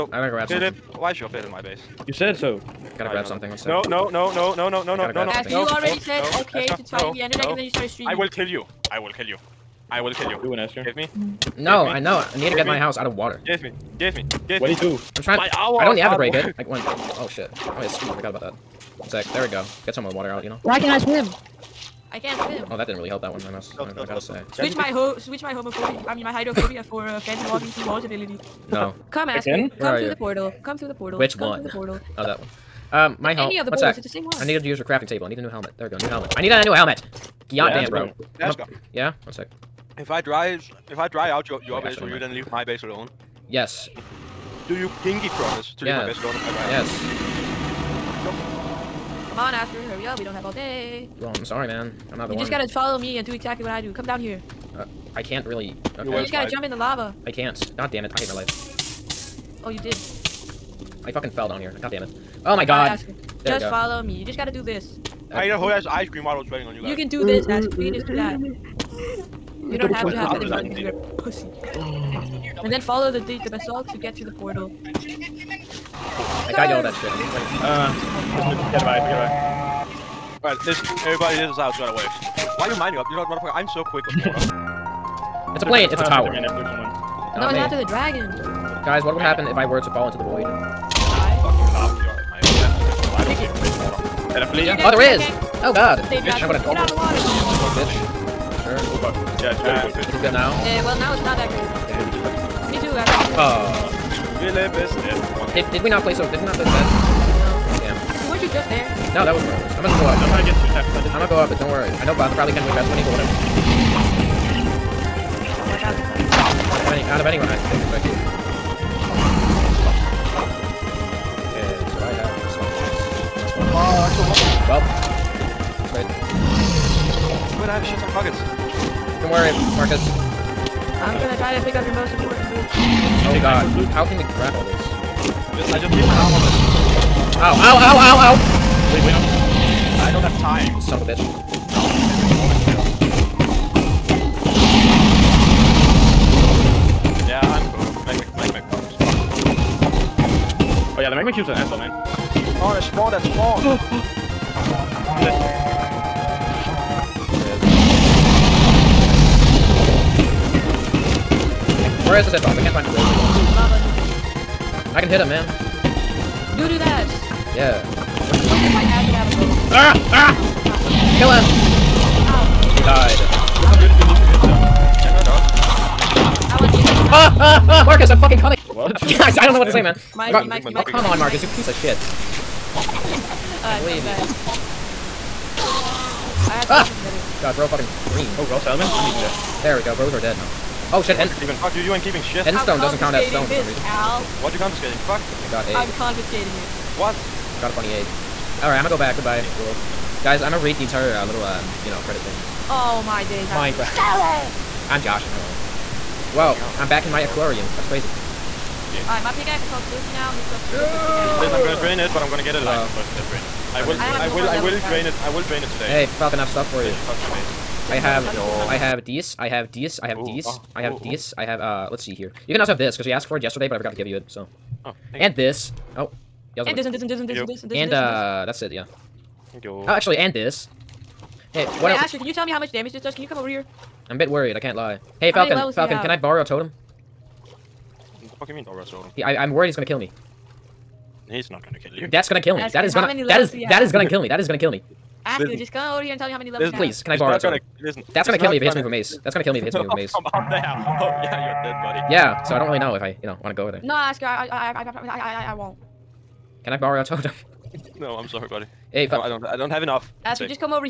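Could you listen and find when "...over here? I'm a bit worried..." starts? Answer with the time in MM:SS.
03:53.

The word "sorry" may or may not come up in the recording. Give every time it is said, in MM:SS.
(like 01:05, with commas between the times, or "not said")
00:51, 04:18.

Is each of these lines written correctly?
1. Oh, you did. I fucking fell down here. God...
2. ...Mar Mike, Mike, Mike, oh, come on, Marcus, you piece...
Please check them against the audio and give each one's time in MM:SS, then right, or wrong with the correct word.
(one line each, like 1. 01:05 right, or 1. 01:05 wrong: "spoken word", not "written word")
1. 00:59 right
2. 03:00 right.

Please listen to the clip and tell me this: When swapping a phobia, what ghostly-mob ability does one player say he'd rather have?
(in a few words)
Phantom walking through walls.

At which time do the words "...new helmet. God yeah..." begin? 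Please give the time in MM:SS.
00:36.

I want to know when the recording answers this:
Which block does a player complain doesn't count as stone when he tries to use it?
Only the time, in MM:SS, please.
03:12.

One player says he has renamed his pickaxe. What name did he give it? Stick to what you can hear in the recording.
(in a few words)
Silky.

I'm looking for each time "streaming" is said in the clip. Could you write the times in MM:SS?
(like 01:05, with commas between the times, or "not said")
00:07.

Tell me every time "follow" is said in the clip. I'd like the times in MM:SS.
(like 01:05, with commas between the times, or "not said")
00:52, 01:03, 01:12.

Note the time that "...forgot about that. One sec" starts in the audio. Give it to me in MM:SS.
00:18.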